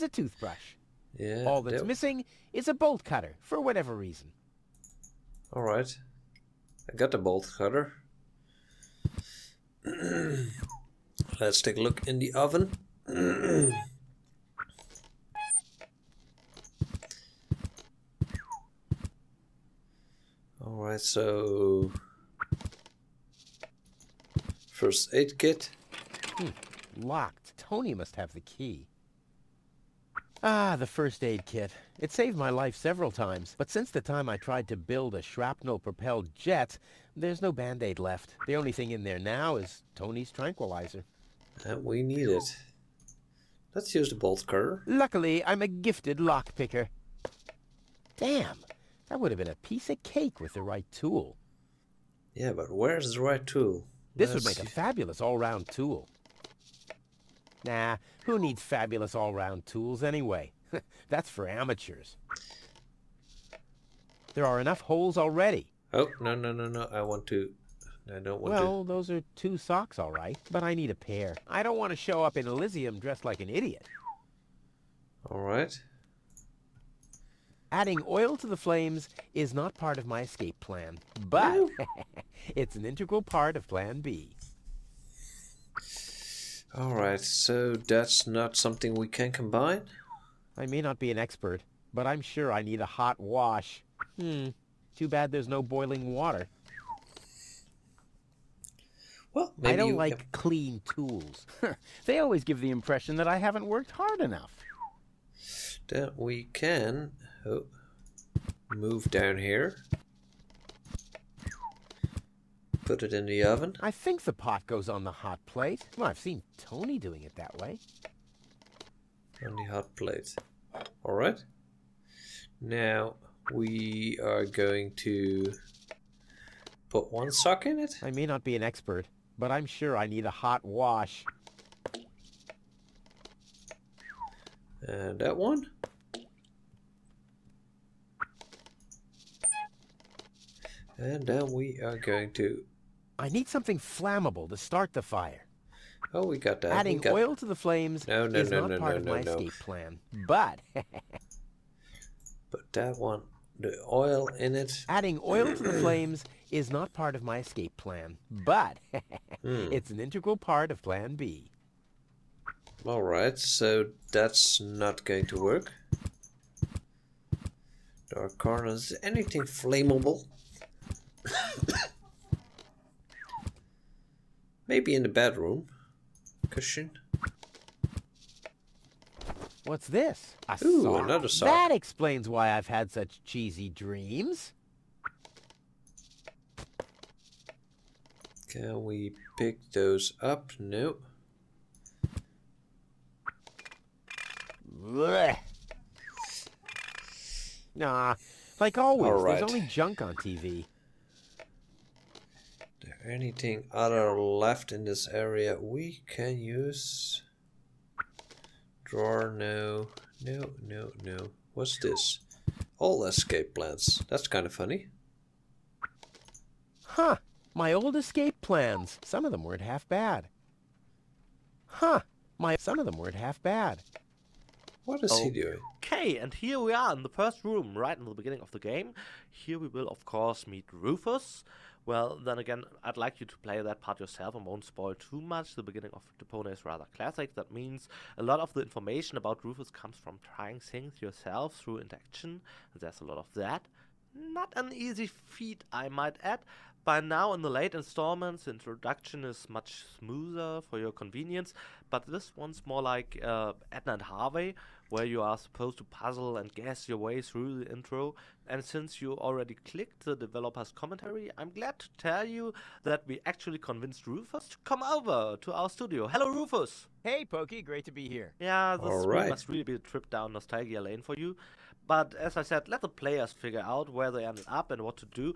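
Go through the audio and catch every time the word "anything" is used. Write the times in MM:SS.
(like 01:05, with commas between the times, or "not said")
02:49, 03:23.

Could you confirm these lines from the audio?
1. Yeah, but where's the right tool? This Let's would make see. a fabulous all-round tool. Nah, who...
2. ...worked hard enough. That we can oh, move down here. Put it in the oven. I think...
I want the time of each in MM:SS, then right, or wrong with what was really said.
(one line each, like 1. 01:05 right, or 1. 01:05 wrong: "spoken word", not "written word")
1. 00:52 right
2. 01:43 right.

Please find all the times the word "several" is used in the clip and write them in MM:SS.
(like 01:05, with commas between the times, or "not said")
00:32.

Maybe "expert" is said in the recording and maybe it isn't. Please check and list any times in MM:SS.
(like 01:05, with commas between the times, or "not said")
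01:31, 02:08.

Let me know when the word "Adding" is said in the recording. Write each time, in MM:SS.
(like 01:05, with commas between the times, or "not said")
01:17, 02:26, 02:34.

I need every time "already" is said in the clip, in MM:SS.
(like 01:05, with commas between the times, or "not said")
01:05, 04:19.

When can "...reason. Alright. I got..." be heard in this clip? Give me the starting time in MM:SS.
00:03.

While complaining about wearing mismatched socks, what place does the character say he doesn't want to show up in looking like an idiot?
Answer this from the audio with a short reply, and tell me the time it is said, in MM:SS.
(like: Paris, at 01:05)
Elysium, at 01:12.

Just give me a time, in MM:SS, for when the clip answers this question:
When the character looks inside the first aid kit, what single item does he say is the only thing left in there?
00:39.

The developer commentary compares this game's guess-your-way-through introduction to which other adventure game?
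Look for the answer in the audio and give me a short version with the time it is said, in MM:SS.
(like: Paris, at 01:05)
Edna and Harvey, at 04:13.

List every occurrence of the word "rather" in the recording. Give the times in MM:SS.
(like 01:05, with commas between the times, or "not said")
03:56.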